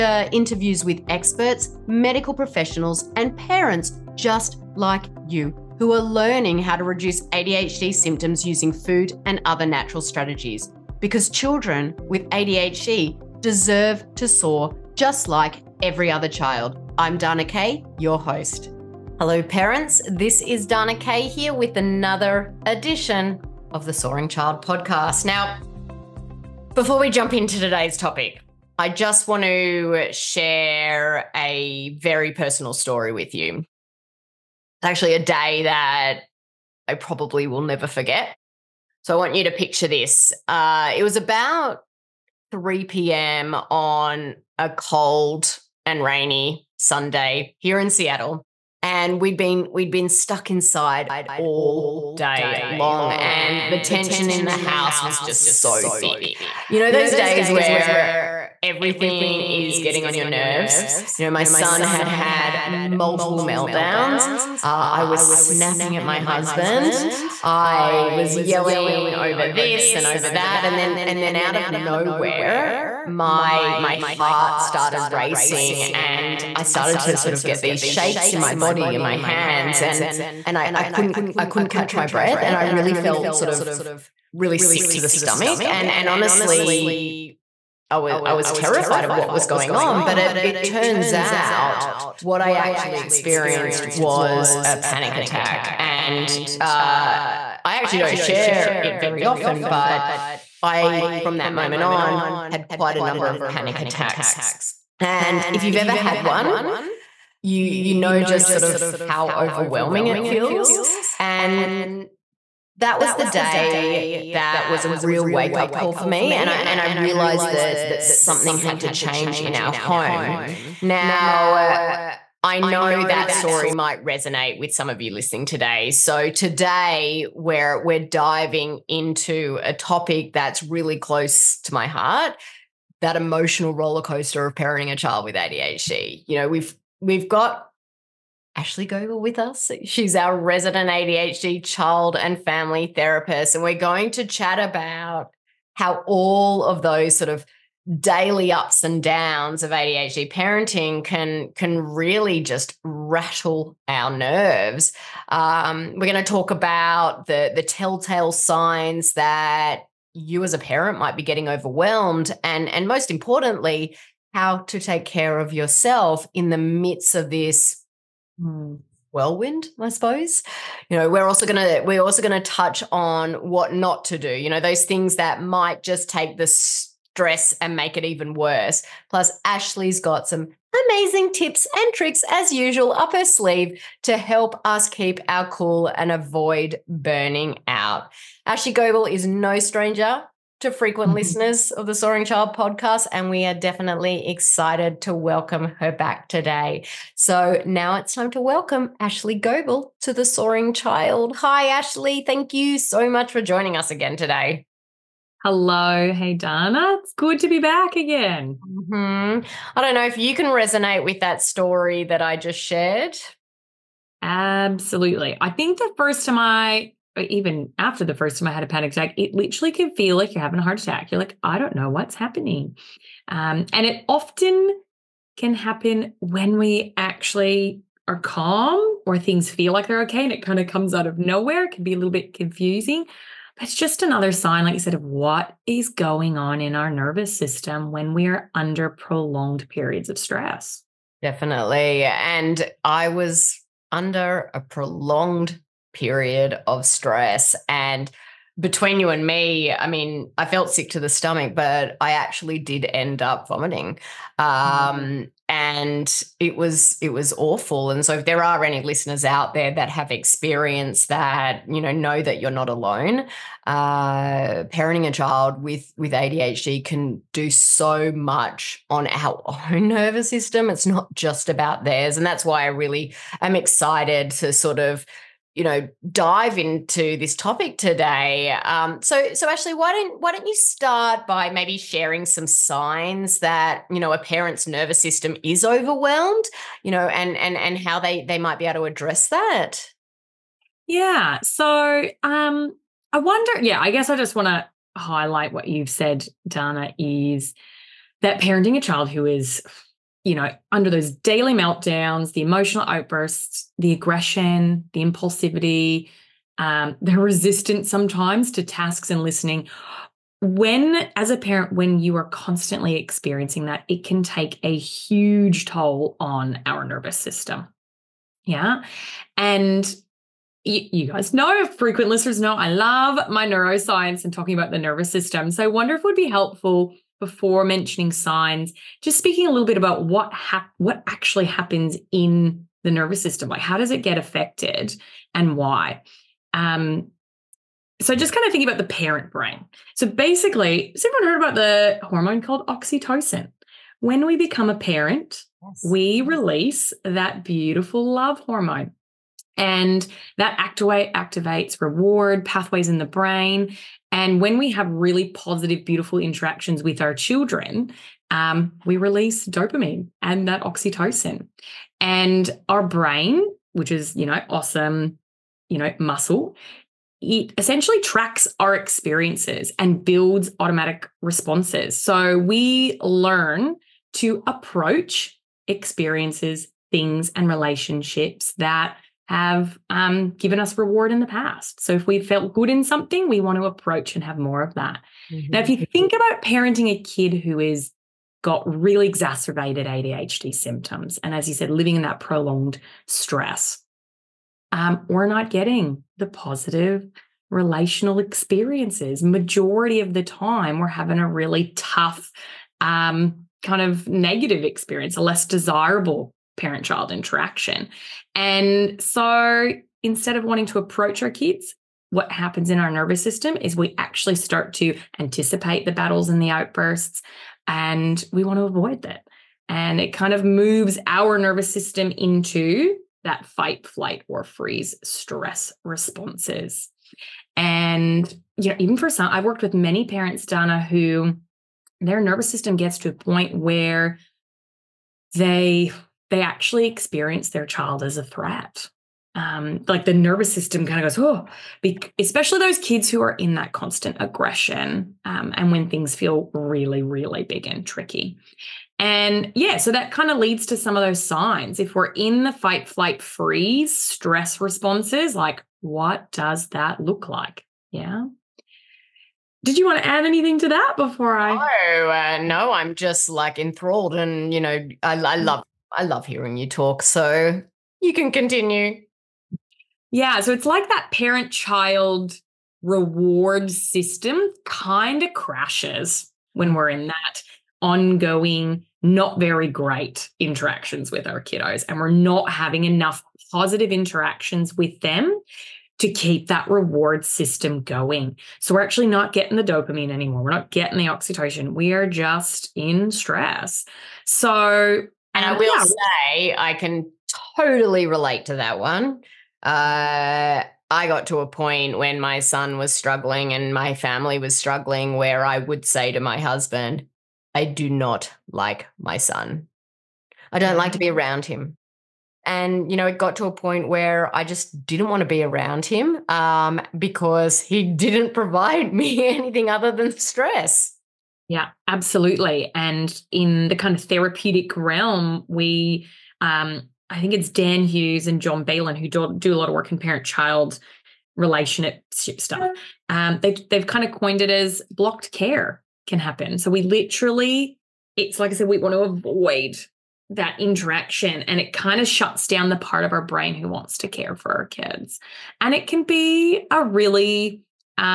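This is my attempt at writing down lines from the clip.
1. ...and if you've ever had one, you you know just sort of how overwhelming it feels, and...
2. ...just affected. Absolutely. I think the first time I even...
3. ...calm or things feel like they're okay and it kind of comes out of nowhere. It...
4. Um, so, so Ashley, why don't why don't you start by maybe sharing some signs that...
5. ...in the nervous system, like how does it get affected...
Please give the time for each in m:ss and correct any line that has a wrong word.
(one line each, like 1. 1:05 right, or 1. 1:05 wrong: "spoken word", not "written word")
1. 1:45 right
2. 3:32 wrong: "shared", not "affected"
3. 3:48 right
4. 4:38 right
5. 5:32 right.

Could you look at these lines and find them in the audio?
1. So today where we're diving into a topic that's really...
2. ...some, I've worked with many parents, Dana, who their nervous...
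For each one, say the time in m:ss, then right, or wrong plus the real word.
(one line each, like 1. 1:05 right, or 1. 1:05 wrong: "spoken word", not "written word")
1. 2:05 right
2. 7:09 right.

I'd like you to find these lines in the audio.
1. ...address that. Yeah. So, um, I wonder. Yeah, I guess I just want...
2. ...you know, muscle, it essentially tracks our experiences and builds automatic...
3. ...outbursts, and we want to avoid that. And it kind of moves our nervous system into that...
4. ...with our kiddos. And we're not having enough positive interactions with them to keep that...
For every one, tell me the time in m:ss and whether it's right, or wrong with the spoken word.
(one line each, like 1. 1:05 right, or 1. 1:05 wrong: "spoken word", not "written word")
1. 4:48 right
2. 6:05 right
3. 6:56 right
4. 8:01 right.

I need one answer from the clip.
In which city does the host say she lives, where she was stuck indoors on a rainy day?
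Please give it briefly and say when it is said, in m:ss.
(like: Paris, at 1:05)
Seattle, at 0:47.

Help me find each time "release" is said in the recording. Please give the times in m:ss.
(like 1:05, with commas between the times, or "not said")
5:46, 5:58.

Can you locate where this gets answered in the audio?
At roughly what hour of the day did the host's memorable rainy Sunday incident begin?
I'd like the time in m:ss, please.
0:42.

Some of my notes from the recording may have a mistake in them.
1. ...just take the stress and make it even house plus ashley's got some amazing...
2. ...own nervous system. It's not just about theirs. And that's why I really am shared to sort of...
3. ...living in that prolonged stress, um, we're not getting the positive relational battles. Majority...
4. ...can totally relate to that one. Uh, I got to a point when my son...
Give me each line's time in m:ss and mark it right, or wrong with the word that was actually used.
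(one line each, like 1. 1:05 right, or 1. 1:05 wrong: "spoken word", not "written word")
1. 2:55 wrong: "worse", not "house"
2. 4:29 wrong: "excited", not "shared"
3. 6:31 wrong: "experiences", not "battles"
4. 8:16 right.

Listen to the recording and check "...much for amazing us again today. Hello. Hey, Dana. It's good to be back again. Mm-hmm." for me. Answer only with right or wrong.
wrong.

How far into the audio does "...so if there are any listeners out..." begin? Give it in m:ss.
4:18.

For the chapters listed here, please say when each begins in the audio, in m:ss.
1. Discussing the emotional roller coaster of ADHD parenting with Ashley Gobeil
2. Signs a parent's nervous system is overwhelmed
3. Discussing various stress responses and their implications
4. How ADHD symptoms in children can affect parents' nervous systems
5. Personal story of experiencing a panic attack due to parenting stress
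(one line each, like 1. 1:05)
1. 2:28
2. 4:56
3. 7:25
4. 3:41
5. 0:21.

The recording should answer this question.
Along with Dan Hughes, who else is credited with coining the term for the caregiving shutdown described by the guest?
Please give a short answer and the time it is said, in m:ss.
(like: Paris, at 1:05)
John Baylin, at 8:48.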